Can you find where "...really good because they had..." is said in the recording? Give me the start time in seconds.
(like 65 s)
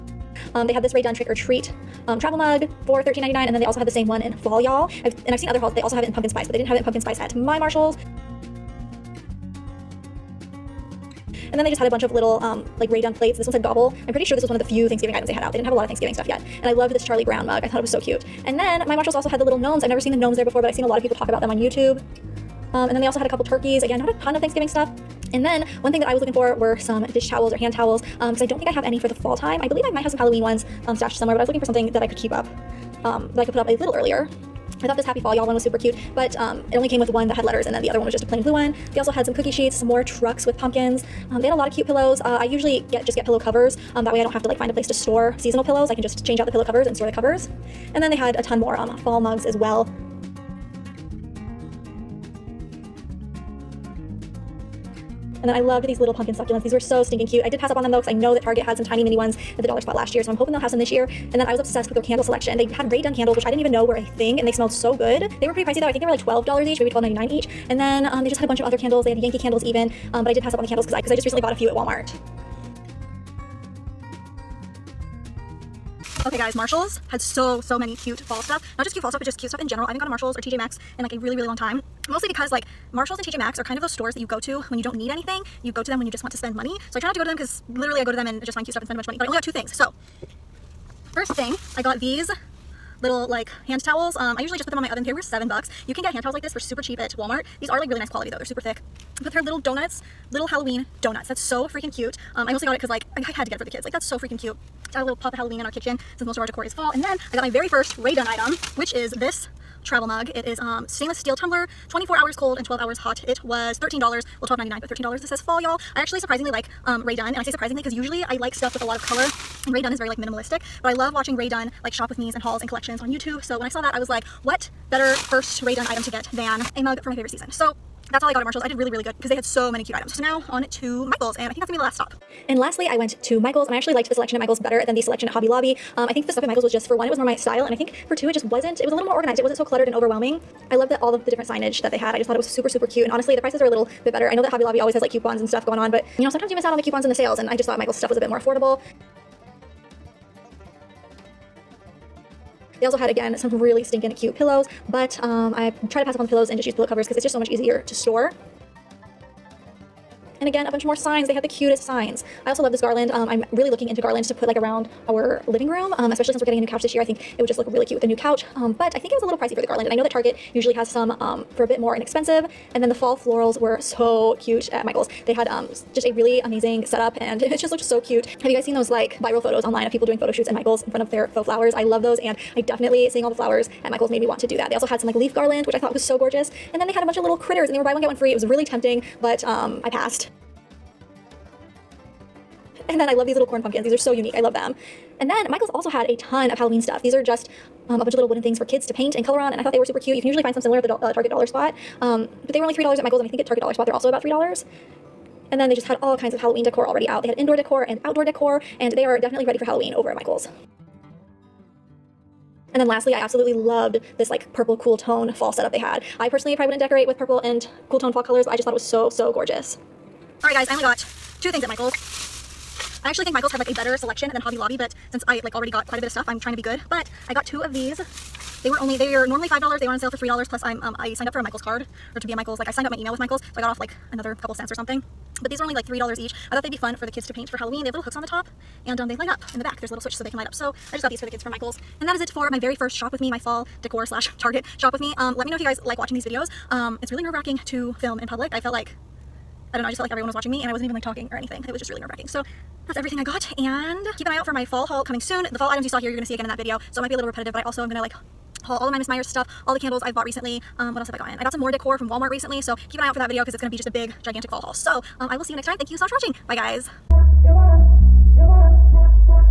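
128 s.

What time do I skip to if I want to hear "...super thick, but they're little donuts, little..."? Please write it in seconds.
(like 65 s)
98 s.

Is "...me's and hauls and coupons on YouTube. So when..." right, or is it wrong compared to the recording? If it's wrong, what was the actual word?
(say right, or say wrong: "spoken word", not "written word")
wrong: "collections", not "coupons".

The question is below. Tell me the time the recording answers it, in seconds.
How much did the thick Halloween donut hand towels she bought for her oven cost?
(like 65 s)
95 s.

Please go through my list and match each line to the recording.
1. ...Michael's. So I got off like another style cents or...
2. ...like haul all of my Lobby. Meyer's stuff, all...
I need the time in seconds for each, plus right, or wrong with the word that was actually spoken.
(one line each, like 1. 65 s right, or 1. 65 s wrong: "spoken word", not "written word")
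1. 233 s wrong: "couple", not "style"
2. 258 s wrong: "Mrs", not "Lobby".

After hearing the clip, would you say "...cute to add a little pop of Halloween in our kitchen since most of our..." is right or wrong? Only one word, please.
right.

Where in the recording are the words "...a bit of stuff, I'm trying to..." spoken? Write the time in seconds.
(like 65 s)
225 s.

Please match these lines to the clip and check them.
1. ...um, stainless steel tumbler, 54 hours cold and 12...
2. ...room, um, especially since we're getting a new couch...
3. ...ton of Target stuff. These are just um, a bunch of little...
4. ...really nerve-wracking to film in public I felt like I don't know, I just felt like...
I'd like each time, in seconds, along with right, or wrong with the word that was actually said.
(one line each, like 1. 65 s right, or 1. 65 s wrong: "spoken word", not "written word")
1. 110 s wrong: "24", not "54"
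2. 165 s right
3. 196 s wrong: "Halloween", not "Target"
4. 247 s right.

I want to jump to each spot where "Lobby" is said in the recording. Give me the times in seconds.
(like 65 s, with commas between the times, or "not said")
135 s, 144 s, 224 s.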